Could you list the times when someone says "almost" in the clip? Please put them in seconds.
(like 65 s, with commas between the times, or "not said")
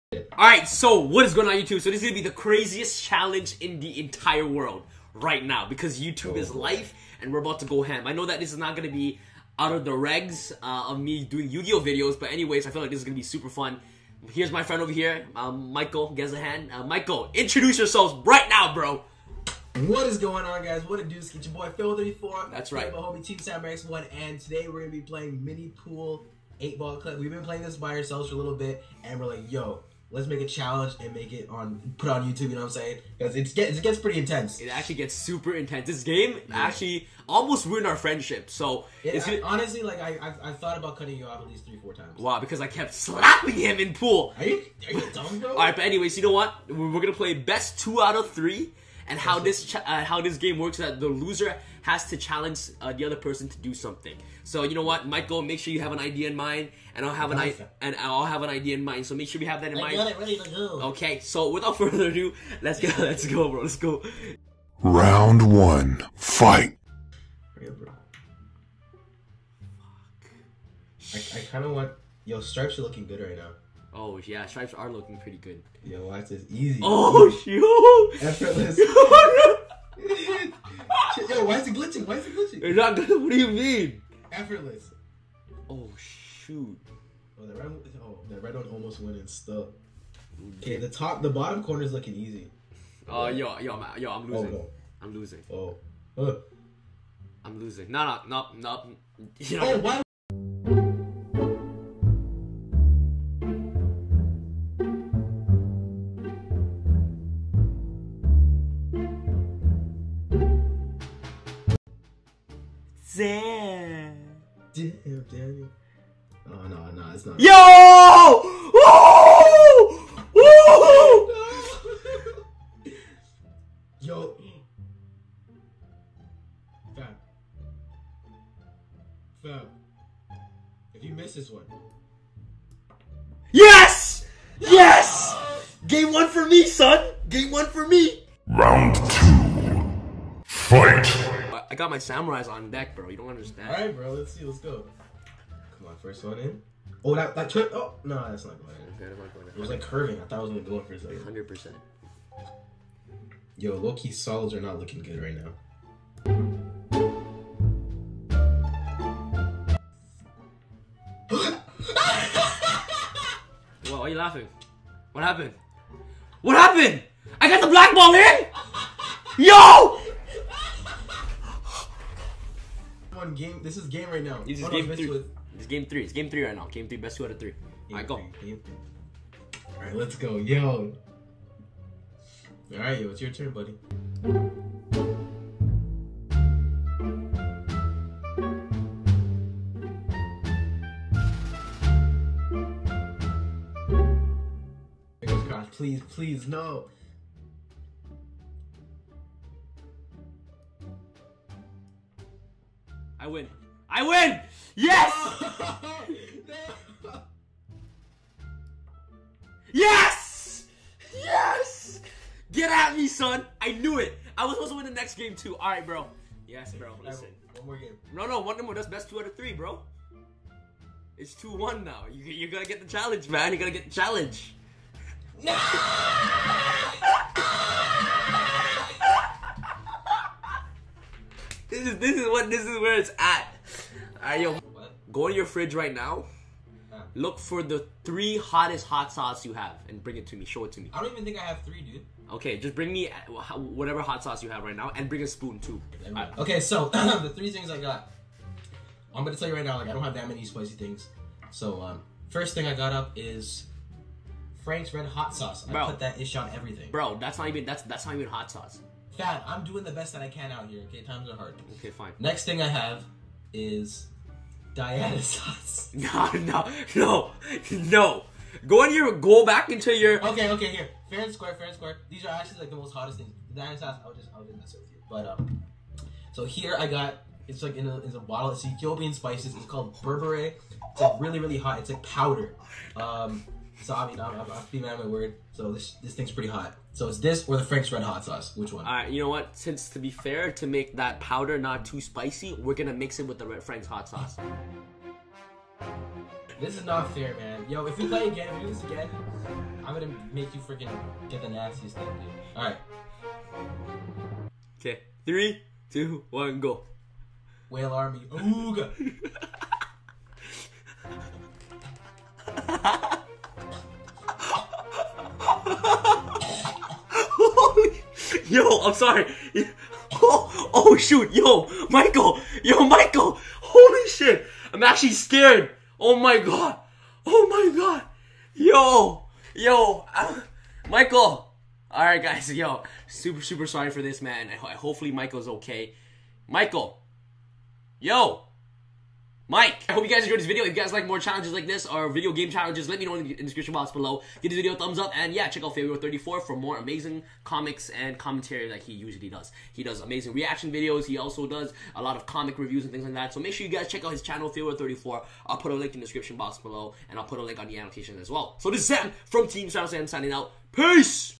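37 s, 88 s.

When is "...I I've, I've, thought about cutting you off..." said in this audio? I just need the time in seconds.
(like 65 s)
40 s.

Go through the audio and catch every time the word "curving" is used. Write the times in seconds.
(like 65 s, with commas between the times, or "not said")
149 s.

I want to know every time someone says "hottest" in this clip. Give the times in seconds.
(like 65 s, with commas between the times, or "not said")
238 s, 272 s.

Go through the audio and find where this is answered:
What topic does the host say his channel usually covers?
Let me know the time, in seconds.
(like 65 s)
11 s.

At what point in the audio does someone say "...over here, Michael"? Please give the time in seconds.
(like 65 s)
14 s.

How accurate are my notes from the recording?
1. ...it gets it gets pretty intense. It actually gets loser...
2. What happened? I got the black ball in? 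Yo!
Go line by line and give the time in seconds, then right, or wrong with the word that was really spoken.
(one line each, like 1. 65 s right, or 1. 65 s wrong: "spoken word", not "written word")
1. 33 s wrong: "super", not "loser"
2. 166 s right.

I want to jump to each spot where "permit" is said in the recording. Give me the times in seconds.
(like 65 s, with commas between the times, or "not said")
not said.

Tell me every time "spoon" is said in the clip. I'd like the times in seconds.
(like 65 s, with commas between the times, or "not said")
245 s.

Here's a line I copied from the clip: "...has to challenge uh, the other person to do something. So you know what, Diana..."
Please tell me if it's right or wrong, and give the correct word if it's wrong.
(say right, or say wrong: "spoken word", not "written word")
wrong: "Michael", not "Diana".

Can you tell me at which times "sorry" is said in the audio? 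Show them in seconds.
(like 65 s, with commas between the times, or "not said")
318 s, 333 s.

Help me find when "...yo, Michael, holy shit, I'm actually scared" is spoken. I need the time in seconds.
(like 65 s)
322 s.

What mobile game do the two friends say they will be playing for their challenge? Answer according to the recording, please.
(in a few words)
Mini Pool Eight Ball Club.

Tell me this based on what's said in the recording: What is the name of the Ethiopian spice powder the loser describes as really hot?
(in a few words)
berbere.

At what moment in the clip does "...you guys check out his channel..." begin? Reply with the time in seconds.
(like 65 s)
353 s.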